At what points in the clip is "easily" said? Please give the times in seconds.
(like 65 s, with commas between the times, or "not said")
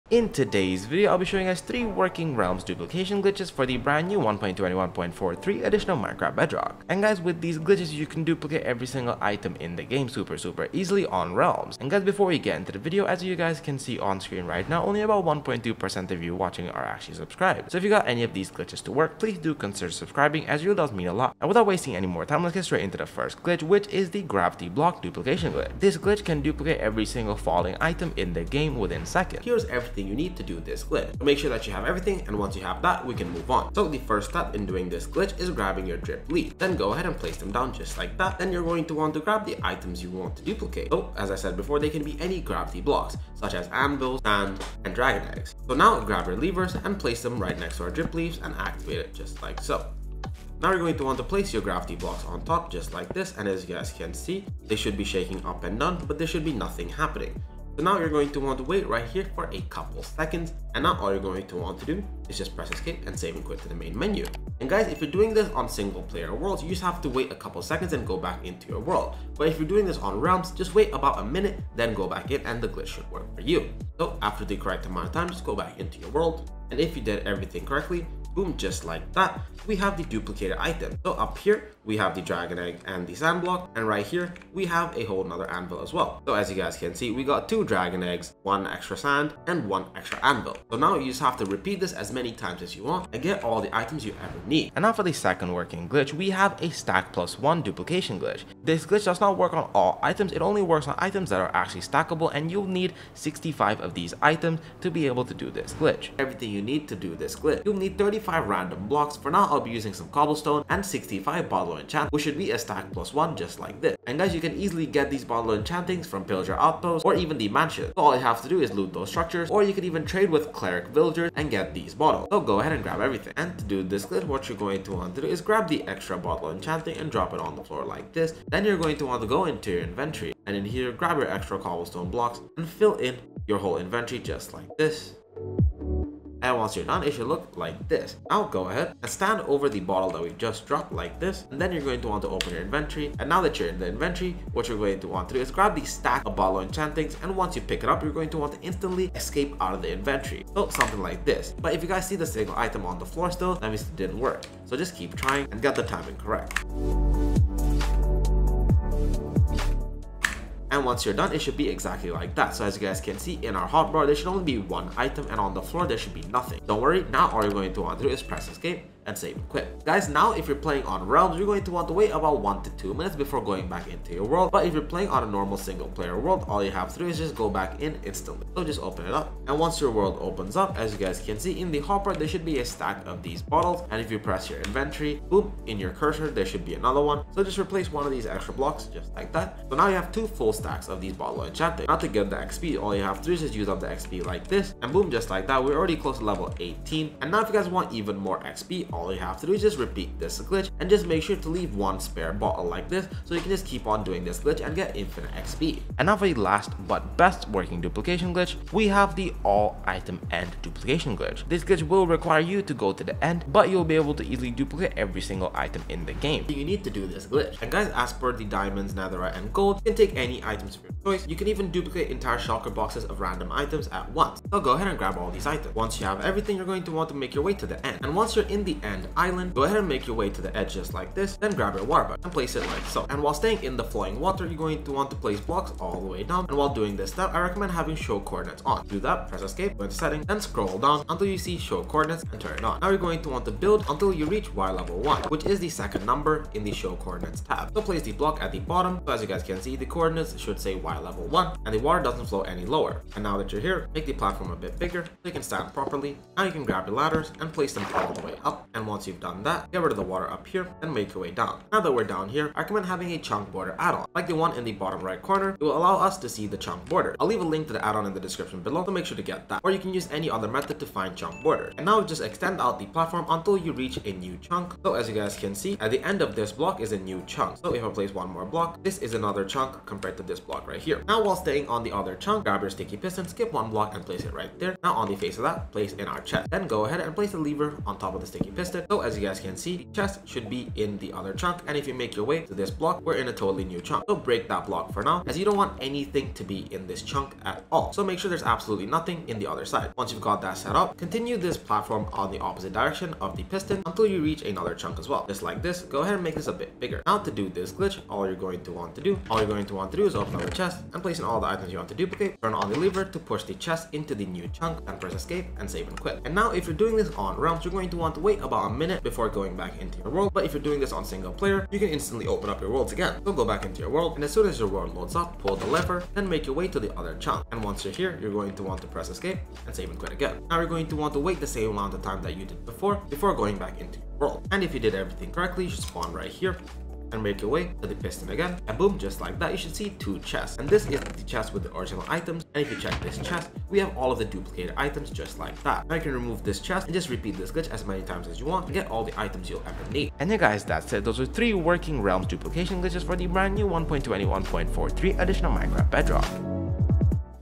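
10 s, 114 s, 214 s.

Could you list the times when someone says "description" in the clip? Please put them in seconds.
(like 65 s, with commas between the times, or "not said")
268 s.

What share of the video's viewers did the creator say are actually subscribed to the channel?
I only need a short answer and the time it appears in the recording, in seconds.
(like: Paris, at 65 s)
1.2%, at 15 s.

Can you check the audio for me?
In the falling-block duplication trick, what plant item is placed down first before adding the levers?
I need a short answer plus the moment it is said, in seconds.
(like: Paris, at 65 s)
Drip leaf, at 35 s.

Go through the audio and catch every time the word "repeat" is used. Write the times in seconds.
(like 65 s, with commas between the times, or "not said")
91 s, 199 s, 347 s.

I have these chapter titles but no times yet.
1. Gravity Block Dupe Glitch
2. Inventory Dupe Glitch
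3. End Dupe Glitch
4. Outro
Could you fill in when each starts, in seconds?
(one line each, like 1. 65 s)
1. 29 s
2. 105 s
3. 216 s
4. 350 s.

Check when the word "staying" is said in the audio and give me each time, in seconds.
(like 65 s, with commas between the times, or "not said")
233 s, 281 s.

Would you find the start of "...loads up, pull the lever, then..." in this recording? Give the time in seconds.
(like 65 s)
324 s.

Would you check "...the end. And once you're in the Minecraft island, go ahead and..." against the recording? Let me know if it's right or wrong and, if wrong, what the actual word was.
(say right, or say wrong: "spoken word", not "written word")
wrong: "End", not "Minecraft".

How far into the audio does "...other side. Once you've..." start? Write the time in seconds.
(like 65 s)
299 s.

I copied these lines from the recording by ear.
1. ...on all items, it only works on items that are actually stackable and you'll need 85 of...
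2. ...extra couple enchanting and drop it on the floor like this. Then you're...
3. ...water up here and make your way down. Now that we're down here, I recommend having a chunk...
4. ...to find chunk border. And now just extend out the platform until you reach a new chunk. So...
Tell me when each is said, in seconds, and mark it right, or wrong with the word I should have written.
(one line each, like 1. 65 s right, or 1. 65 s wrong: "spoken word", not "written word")
1. 99 s wrong: "65", not "85"
2. 125 s wrong: "bottle", not "couple"
3. 260 s right
4. 270 s right.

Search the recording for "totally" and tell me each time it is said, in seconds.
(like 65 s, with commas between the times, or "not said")
293 s.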